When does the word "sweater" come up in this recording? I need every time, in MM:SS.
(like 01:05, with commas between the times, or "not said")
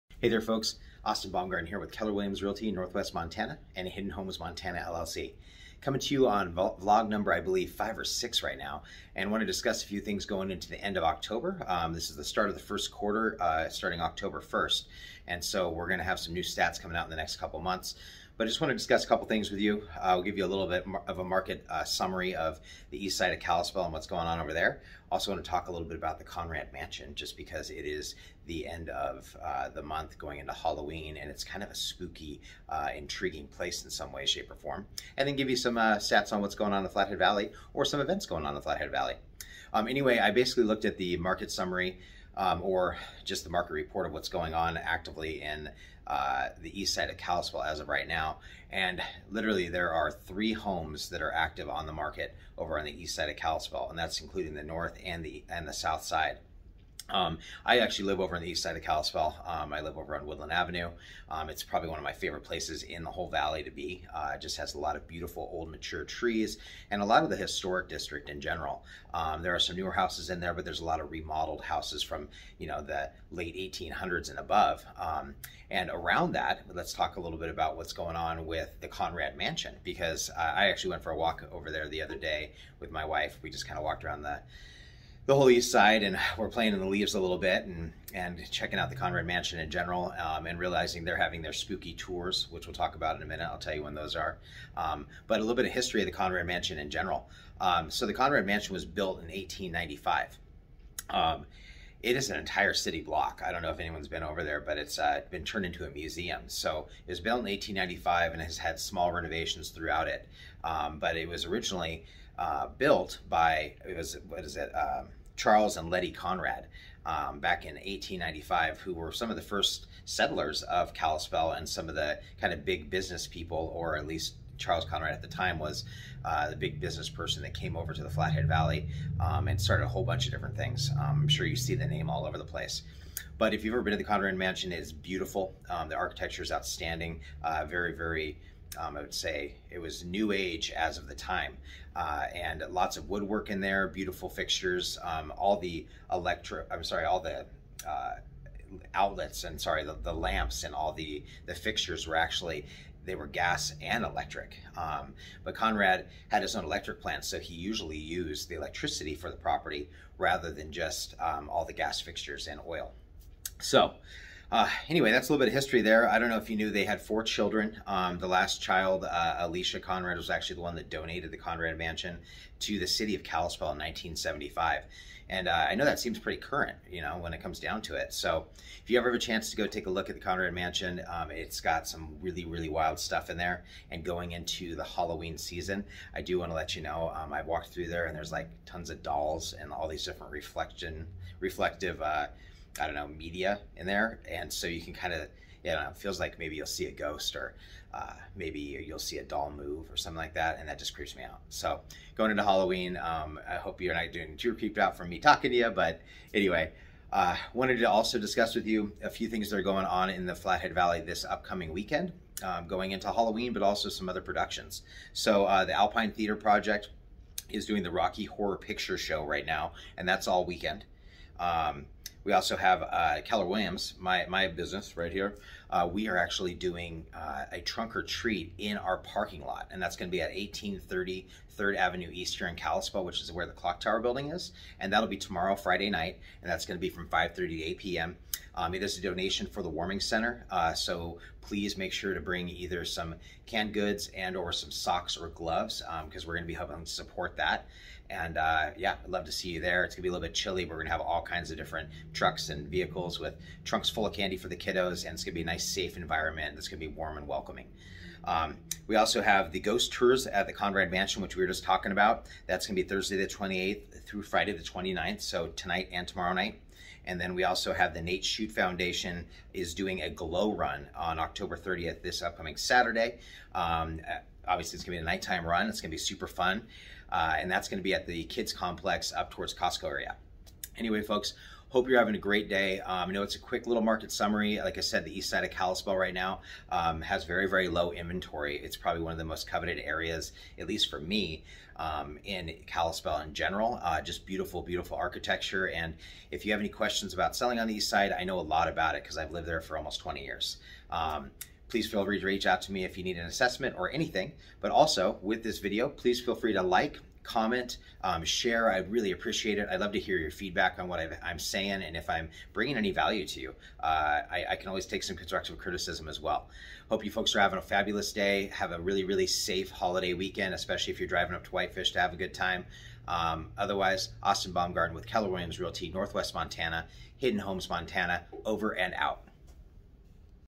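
not said.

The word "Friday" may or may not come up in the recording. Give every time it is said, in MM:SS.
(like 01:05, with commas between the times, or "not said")
03:55, 04:24.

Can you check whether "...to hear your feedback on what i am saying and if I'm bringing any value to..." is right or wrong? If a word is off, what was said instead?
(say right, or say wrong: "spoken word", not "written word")
right.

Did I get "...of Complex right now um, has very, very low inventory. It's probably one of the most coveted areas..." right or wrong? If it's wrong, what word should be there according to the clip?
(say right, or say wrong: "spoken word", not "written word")
wrong: "Kalispell", not "Complex".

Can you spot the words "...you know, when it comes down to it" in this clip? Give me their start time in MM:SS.
02:56.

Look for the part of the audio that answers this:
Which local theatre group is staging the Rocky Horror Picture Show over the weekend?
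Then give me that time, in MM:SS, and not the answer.
03:35.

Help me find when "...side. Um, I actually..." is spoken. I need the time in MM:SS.
00:56.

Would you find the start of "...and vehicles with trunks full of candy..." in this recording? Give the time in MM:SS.
04:12.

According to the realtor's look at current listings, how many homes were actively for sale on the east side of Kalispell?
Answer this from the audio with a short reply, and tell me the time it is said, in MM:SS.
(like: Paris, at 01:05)
3, at 00:50.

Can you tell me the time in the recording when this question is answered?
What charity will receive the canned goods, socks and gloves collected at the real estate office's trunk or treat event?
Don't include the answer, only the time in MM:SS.
03:59.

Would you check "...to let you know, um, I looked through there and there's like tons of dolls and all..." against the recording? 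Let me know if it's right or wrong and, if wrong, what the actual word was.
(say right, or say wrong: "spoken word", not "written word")
wrong: "walked", not "looked".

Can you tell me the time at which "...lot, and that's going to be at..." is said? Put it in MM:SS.
03:49.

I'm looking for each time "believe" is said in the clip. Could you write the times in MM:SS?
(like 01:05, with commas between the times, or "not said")
00:07.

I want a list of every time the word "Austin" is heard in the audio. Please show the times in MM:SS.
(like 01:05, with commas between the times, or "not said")
00:01, 05:24.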